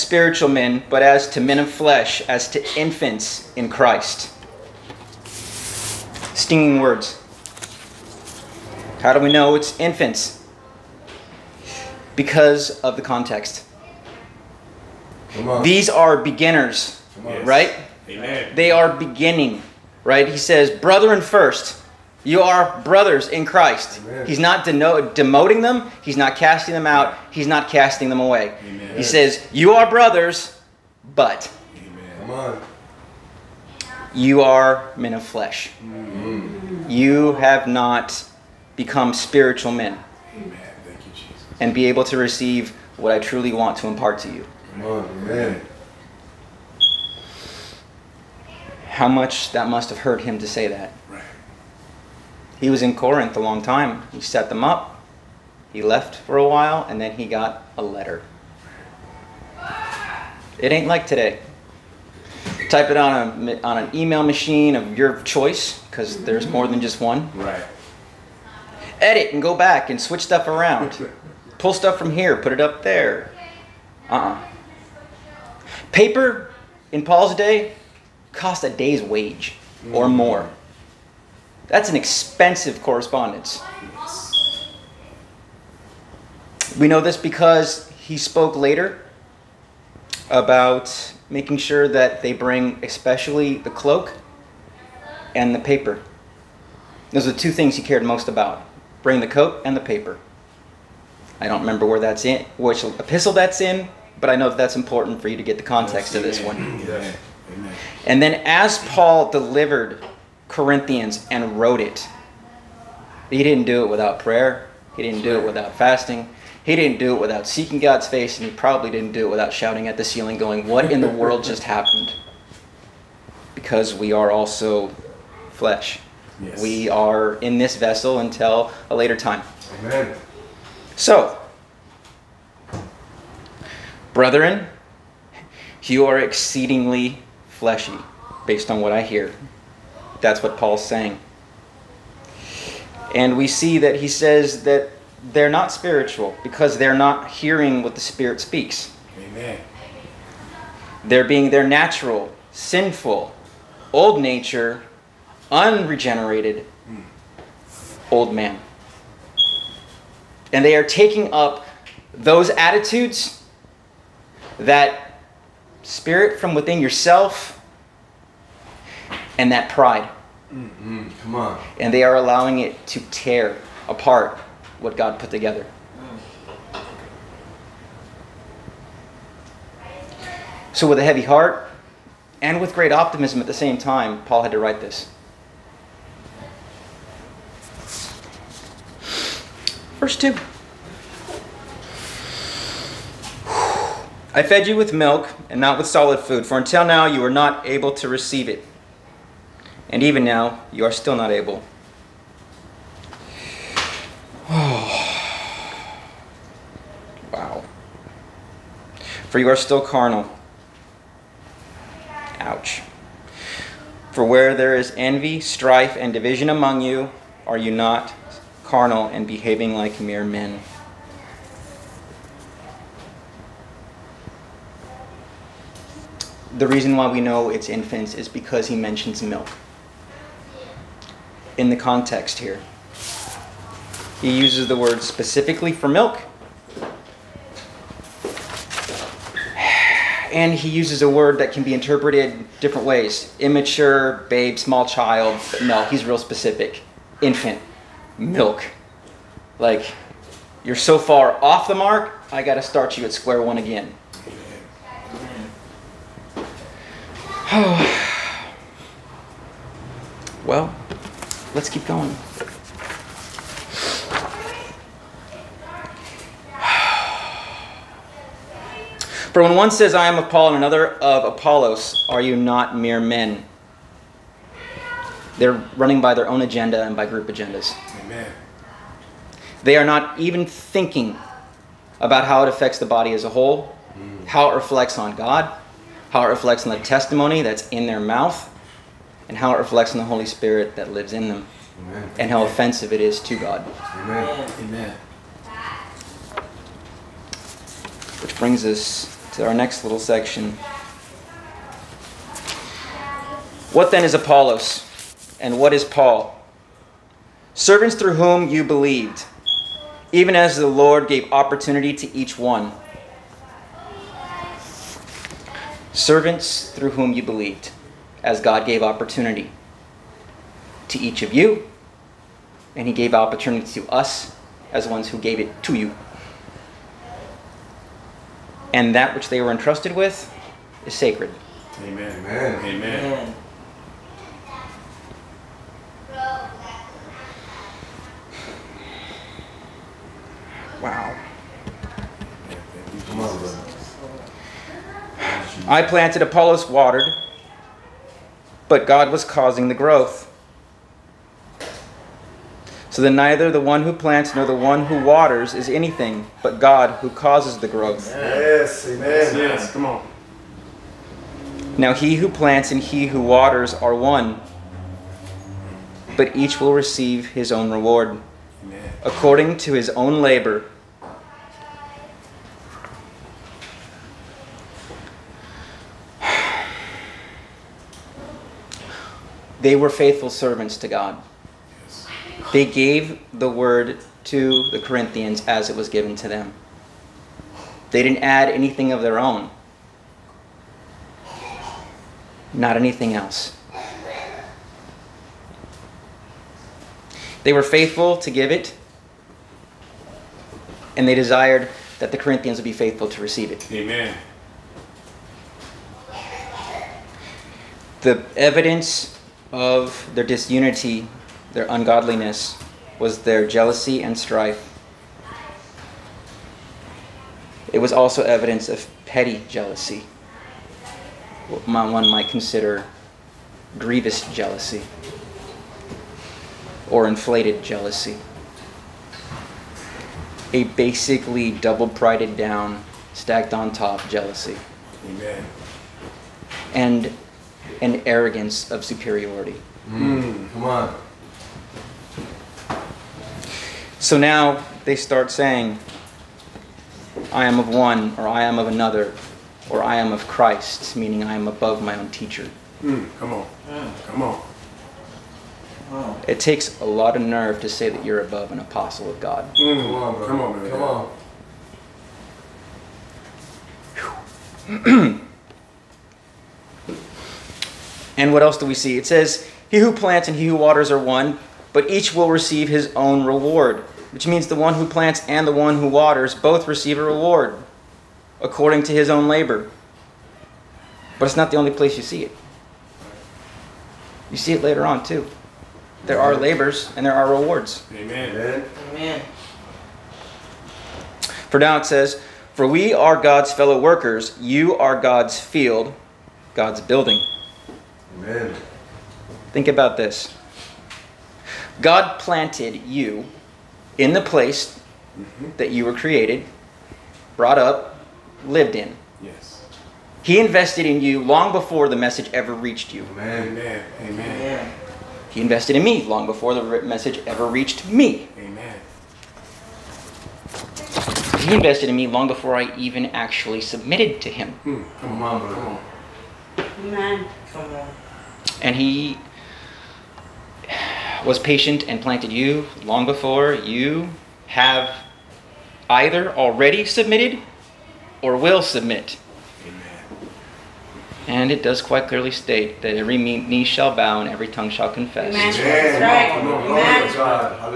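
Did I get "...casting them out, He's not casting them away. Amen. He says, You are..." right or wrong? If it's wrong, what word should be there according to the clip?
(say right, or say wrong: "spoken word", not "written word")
right.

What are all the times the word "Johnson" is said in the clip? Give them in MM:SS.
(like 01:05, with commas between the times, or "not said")
not said.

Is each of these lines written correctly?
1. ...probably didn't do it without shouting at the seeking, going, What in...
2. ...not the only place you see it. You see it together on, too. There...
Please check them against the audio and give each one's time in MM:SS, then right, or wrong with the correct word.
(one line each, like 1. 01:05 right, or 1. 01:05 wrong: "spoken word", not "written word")
1. 01:58 wrong: "ceiling", not "seeking"
2. 08:01 wrong: "later", not "together".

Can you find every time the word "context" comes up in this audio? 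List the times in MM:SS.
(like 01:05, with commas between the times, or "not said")
00:13, 01:45, 03:51.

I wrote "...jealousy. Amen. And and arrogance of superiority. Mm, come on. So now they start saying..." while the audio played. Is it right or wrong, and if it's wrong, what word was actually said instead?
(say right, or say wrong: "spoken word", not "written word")
right.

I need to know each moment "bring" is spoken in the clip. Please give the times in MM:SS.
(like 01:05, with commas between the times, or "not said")
01:32, 01:39, 04:58.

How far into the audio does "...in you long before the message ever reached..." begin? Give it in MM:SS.
08:30.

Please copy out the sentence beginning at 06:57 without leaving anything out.
It was also evidence of petty jealousy, what one might consider grievous jealousy or inflated jealousy.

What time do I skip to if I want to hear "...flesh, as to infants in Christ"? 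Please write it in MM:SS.
00:01.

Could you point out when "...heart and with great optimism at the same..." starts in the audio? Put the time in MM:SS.
03:01.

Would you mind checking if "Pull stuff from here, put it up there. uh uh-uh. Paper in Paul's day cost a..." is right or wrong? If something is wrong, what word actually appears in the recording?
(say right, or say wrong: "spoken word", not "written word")
right.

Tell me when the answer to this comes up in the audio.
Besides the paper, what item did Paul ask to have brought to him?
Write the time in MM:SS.
01:33.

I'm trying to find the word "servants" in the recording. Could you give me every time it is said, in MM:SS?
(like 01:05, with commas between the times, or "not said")
05:07, 05:15, 06:20.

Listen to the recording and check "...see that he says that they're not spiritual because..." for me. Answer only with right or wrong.
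right.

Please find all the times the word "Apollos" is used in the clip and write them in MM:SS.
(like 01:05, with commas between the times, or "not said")
04:31, 05:04, 05:46.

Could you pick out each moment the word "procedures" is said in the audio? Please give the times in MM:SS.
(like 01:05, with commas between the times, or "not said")
not said.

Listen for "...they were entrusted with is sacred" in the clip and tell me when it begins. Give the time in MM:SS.
05:29.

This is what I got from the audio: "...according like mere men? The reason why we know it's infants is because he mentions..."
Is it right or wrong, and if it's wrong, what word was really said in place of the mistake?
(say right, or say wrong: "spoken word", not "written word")
wrong: "behaving", not "according".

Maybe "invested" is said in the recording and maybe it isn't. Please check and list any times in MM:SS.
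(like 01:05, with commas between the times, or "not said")
08:30, 08:35, 08:41.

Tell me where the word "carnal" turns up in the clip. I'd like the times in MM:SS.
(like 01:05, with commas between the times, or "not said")
03:29, 03:38.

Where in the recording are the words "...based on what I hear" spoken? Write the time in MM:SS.
02:18.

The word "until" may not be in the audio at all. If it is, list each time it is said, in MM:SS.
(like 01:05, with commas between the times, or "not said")
02:08, 03:16.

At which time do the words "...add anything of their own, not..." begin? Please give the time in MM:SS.
06:28.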